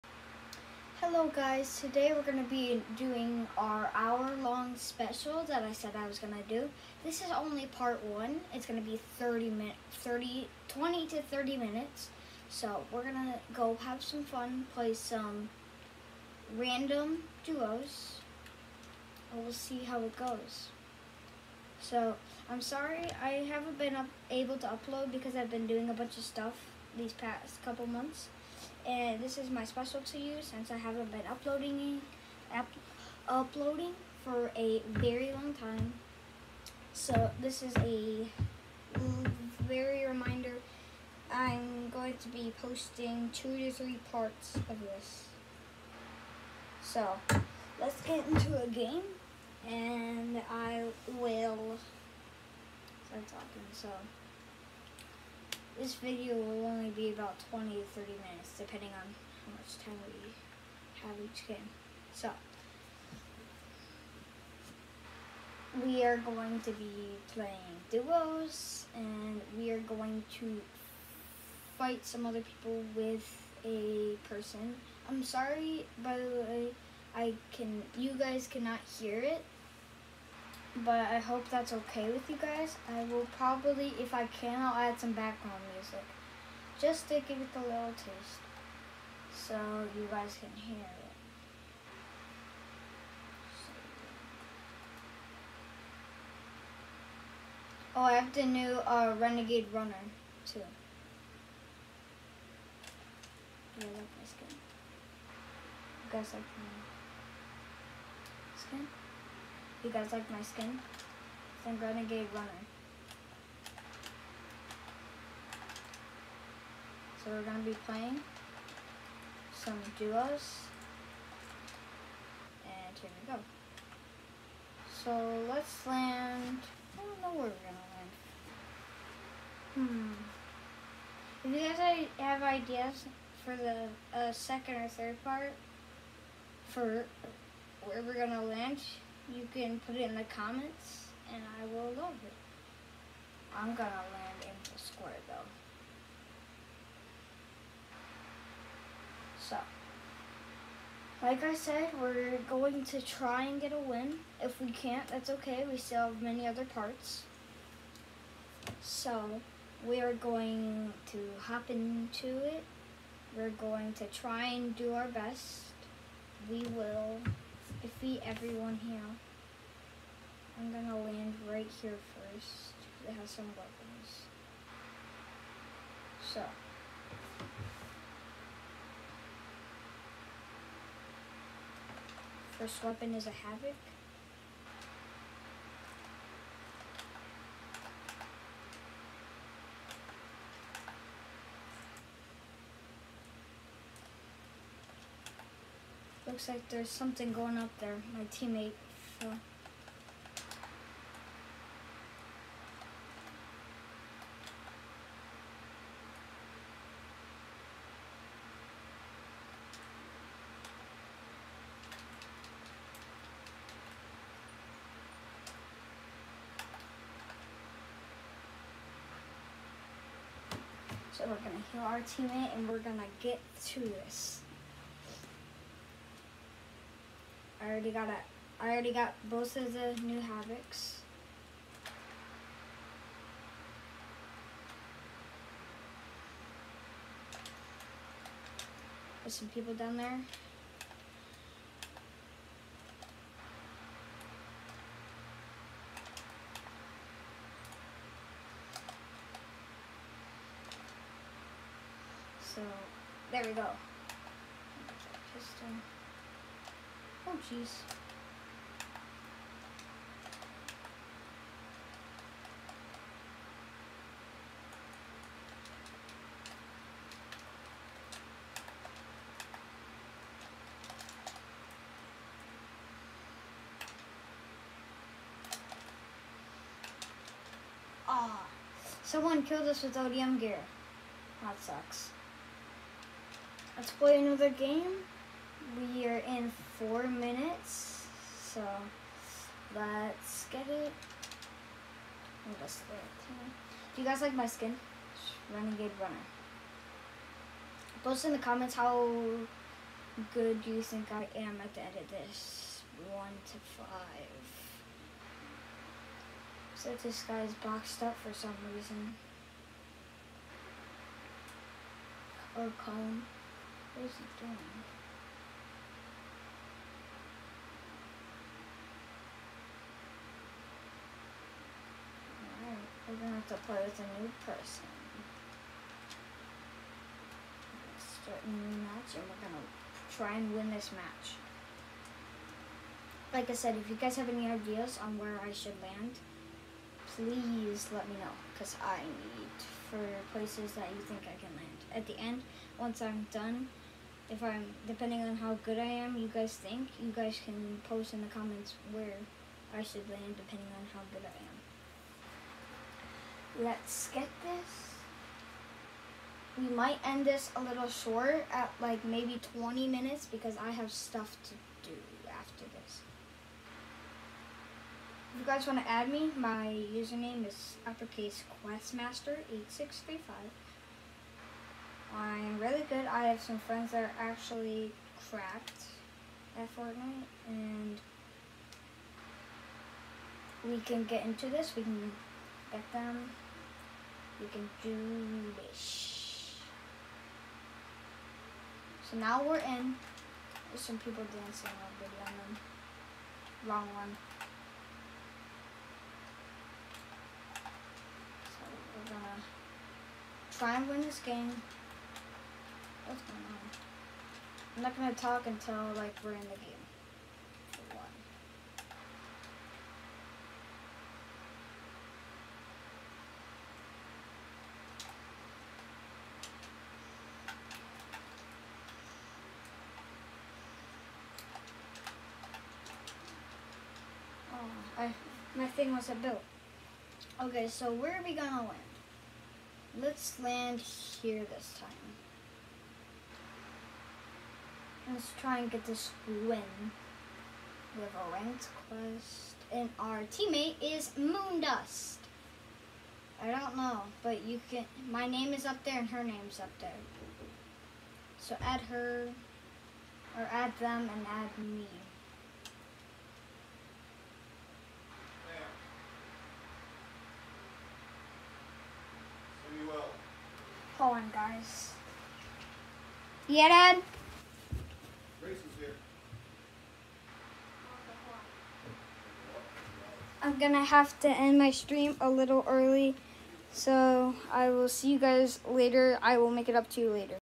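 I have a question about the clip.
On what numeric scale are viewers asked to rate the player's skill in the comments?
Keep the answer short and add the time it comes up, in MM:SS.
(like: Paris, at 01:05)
1 to 5, at 05:03.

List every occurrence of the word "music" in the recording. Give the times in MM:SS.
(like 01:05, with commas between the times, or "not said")
01:25.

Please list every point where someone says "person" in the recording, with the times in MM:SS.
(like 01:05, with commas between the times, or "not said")
01:14, 05:24.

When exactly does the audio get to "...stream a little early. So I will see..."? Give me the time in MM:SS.
07:51.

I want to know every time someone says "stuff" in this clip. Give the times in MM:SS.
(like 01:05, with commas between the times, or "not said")
00:26, 06:00.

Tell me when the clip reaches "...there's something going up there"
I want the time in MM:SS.
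03:16.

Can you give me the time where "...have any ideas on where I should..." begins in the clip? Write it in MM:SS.
05:34.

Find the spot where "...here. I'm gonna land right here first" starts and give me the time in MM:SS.
02:48.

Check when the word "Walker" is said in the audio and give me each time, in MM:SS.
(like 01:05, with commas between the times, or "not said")
not said.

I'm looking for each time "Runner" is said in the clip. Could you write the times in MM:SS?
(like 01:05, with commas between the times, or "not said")
01:39, 01:52, 04:56.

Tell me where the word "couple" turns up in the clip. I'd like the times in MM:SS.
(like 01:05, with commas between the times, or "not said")
00:27.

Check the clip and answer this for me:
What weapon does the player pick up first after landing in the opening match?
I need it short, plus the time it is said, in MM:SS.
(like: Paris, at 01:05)
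Havoc, at 03:03.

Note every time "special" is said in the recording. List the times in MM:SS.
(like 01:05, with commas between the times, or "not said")
00:04, 00:29.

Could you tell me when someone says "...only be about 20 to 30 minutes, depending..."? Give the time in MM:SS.
00:56.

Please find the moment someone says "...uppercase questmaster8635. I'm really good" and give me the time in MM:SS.
06:07.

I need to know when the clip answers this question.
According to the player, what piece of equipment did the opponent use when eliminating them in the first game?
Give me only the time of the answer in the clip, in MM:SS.
04:39.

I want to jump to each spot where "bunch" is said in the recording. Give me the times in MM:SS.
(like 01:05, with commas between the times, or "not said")
00:25.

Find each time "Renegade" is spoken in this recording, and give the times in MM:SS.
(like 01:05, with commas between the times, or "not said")
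01:39, 01:51, 04:55.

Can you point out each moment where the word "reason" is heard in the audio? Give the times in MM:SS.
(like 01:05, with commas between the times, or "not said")
05:08.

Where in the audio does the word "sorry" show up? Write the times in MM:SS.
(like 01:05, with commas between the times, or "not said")
00:22, 01:15.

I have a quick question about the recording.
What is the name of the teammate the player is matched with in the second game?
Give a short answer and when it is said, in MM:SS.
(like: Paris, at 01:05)
Moondust, at 07:21.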